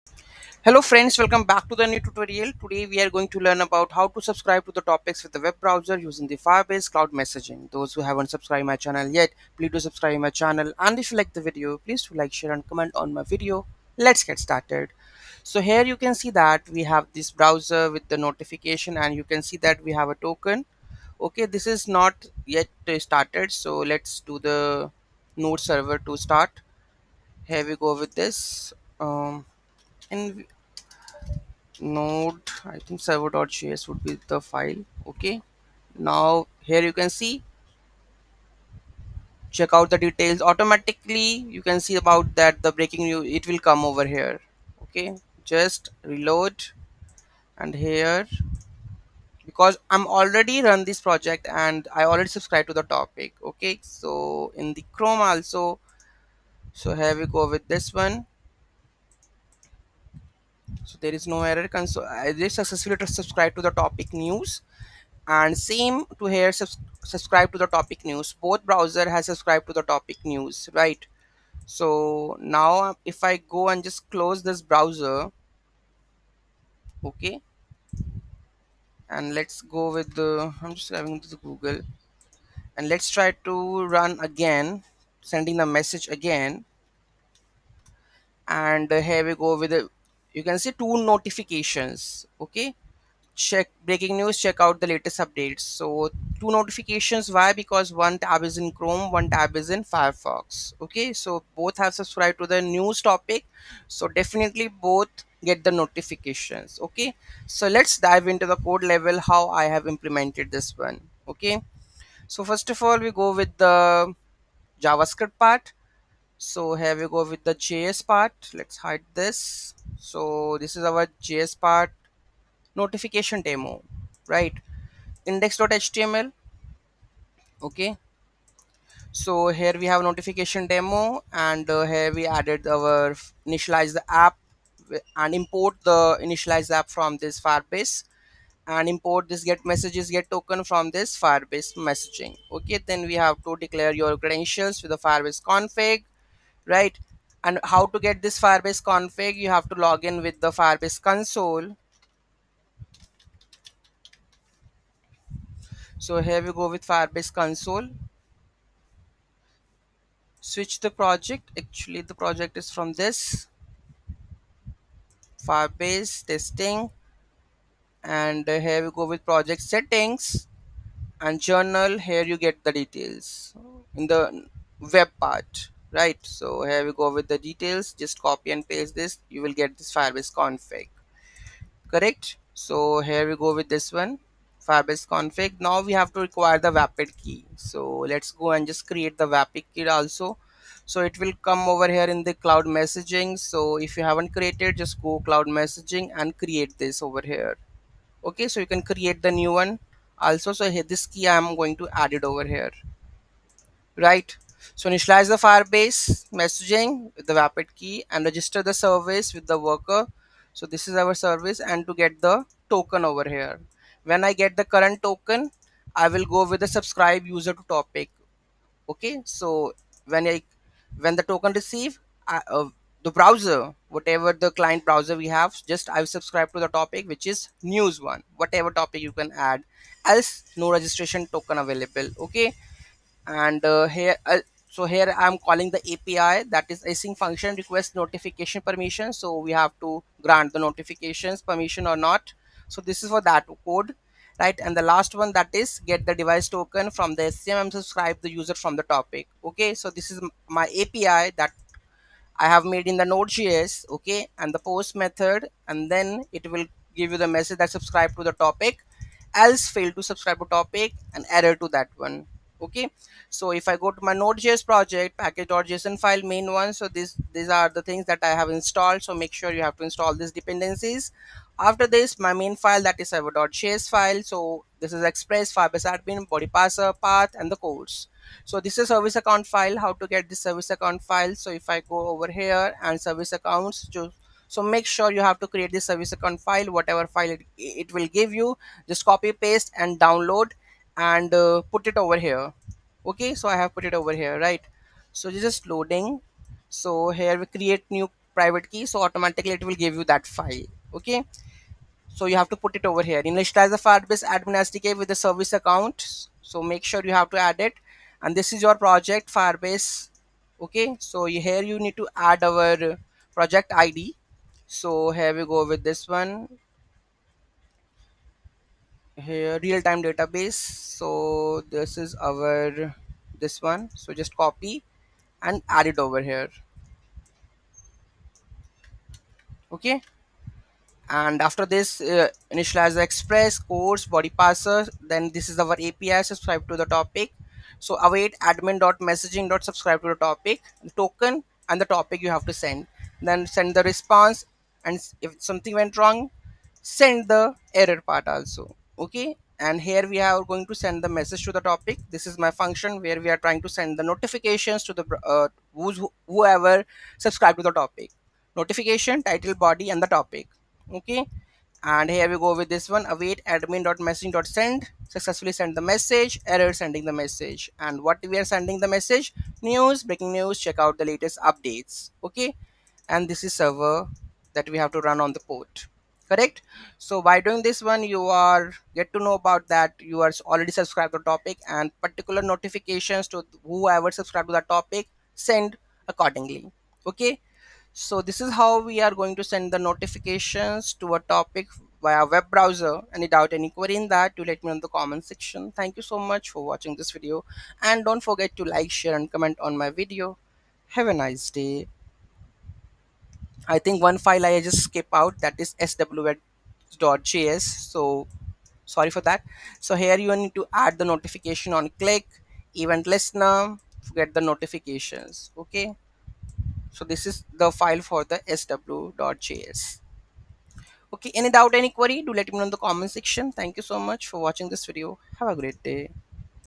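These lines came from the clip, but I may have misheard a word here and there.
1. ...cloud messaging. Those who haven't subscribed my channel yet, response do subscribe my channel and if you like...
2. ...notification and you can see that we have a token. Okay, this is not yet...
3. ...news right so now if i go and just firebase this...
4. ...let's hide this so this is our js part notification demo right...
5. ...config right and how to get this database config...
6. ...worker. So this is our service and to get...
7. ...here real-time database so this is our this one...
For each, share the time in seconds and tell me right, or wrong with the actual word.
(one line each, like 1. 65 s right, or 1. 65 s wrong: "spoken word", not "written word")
1. 6 s wrong: "please", not "response"
2. 18 s right
3. 70 s wrong: "close", not "firebase"
4. 118 s right
5. 145 s wrong: "firebase", not "database"
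6. 209 s right
7. 319 s right.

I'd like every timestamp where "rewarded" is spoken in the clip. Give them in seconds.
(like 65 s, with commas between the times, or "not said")
not said.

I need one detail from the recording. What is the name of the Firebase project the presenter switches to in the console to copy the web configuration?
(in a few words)
firebase testing.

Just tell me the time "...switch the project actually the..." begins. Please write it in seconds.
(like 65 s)
160 s.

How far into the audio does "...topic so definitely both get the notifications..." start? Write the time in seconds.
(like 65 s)
103 s.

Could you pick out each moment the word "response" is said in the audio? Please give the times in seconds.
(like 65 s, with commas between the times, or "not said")
343 s.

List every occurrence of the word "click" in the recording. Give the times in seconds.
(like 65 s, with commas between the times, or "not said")
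411 s.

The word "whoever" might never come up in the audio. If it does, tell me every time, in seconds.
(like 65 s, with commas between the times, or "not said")
356 s, 383 s.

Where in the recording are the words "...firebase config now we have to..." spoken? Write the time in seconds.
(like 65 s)
184 s.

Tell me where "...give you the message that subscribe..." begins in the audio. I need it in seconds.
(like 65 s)
256 s.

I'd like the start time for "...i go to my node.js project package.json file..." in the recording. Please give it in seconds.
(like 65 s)
263 s.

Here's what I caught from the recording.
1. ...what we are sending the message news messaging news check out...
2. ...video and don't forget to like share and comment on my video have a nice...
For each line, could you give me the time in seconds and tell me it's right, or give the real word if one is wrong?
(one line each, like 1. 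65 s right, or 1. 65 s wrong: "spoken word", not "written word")
1. 368 s wrong: "breaking", not "messaging"
2. 397 s right.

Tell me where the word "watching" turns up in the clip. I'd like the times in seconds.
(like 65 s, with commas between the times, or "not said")
396 s, 424 s.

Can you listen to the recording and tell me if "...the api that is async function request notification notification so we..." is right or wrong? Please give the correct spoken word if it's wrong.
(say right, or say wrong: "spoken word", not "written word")
wrong: "permission", not "notification".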